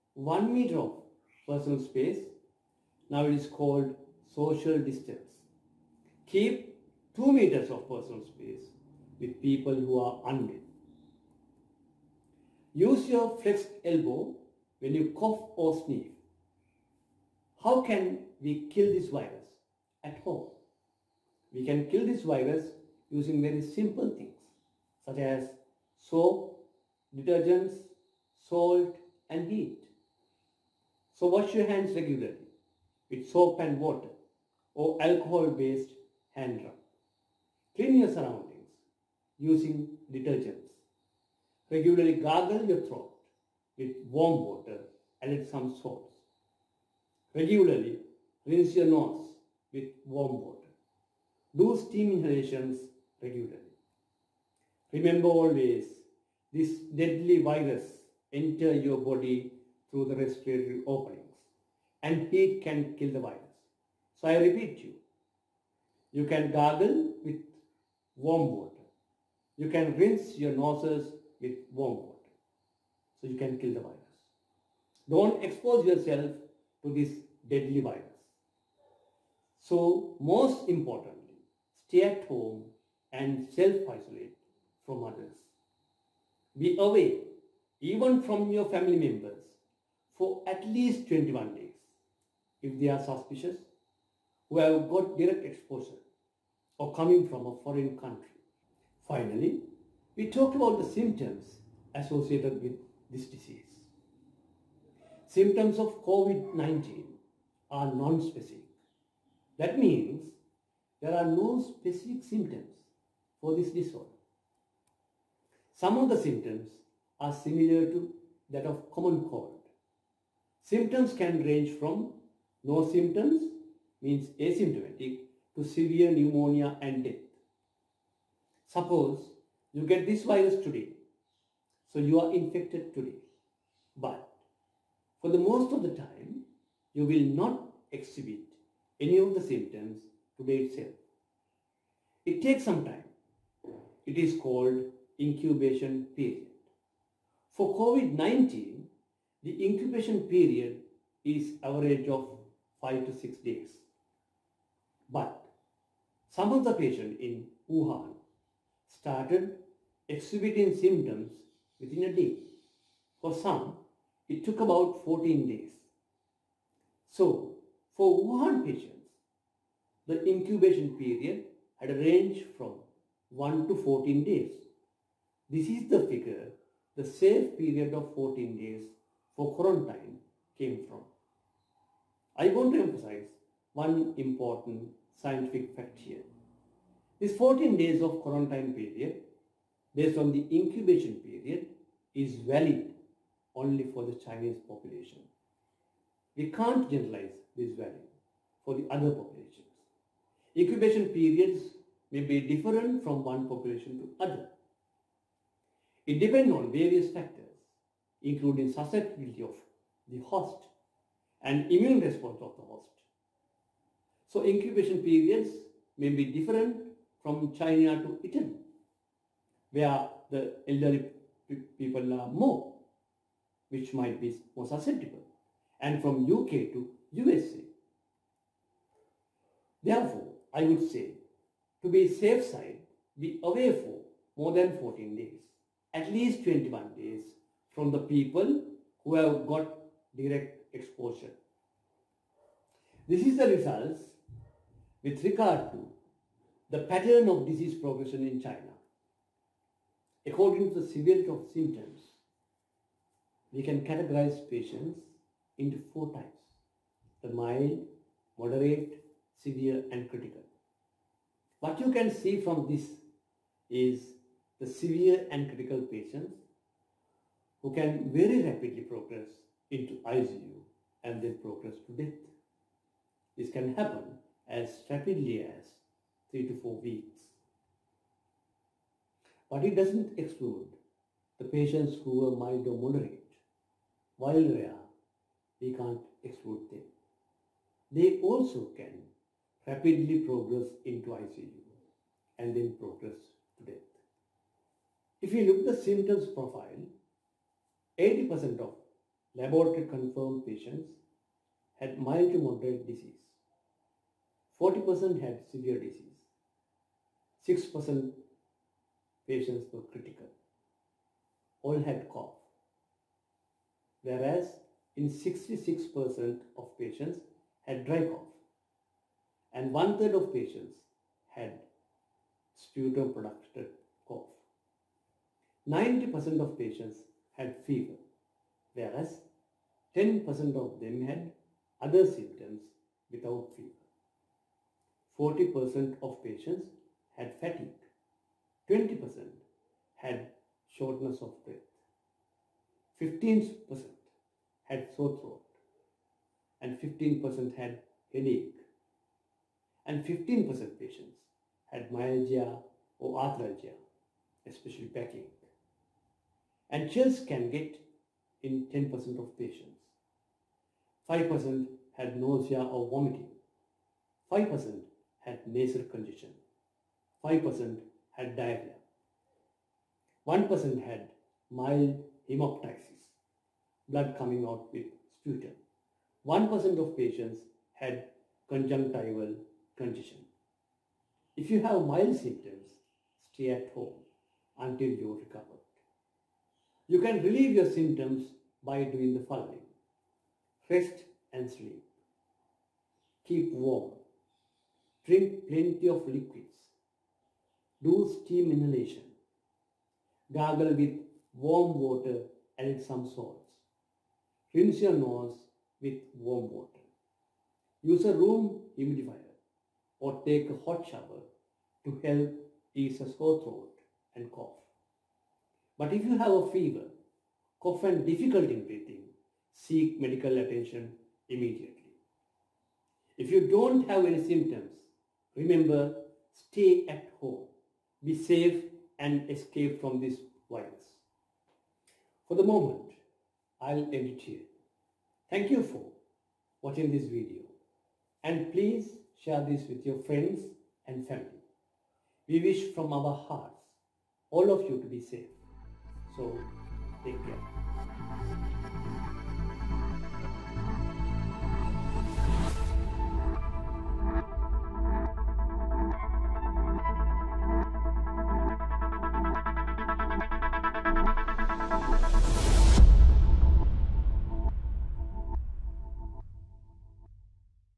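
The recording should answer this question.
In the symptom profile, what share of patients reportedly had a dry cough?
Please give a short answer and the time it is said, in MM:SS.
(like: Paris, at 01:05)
66%, at 05:15.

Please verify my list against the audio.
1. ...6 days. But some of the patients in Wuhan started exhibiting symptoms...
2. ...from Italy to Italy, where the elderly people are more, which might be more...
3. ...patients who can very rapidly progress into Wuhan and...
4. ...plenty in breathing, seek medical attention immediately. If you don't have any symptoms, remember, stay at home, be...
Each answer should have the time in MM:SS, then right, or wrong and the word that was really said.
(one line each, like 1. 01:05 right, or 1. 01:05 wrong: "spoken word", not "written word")
1. 02:33 right
2. 03:37 wrong: "China", not "Italy"
3. 04:25 wrong: "ICU", not "Wuhan"
4. 06:58 wrong: "difficulty", not "plenty".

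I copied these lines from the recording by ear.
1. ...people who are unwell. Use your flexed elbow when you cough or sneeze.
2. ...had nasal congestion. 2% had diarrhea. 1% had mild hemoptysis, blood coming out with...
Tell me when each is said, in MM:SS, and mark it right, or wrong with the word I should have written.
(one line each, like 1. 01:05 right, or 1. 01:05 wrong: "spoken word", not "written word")
1. 00:09 right
2. 06:05 wrong: "5", not "2".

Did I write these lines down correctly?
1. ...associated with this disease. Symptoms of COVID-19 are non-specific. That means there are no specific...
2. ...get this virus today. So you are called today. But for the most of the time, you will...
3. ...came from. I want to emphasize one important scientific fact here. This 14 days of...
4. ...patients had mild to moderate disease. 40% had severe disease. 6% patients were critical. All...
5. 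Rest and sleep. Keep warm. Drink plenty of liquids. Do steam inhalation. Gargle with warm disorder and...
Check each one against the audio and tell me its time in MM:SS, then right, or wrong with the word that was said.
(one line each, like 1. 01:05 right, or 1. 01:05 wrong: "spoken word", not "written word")
1. 01:41 right
2. 02:09 wrong: "infected", not "called"
3. 03:00 right
4. 05:00 right
5. 06:30 wrong: "water", not "disorder".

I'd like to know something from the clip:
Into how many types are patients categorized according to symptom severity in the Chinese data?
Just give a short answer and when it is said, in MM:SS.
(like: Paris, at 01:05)
4, at 04:15.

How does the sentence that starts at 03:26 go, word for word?
It depends on various factors, including susceptibility of the host and immune response of the host.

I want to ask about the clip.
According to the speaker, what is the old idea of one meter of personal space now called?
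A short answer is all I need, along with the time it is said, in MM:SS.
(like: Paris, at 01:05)
social distance, at 00:04.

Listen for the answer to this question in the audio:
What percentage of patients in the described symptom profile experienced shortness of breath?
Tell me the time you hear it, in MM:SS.
05:38.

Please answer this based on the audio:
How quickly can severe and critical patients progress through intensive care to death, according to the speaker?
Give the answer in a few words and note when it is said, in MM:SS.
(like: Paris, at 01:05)
3 to 4 weeks, at 04:36.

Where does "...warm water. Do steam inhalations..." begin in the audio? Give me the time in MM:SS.
00:50.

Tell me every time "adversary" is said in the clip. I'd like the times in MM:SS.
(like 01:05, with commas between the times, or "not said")
not said.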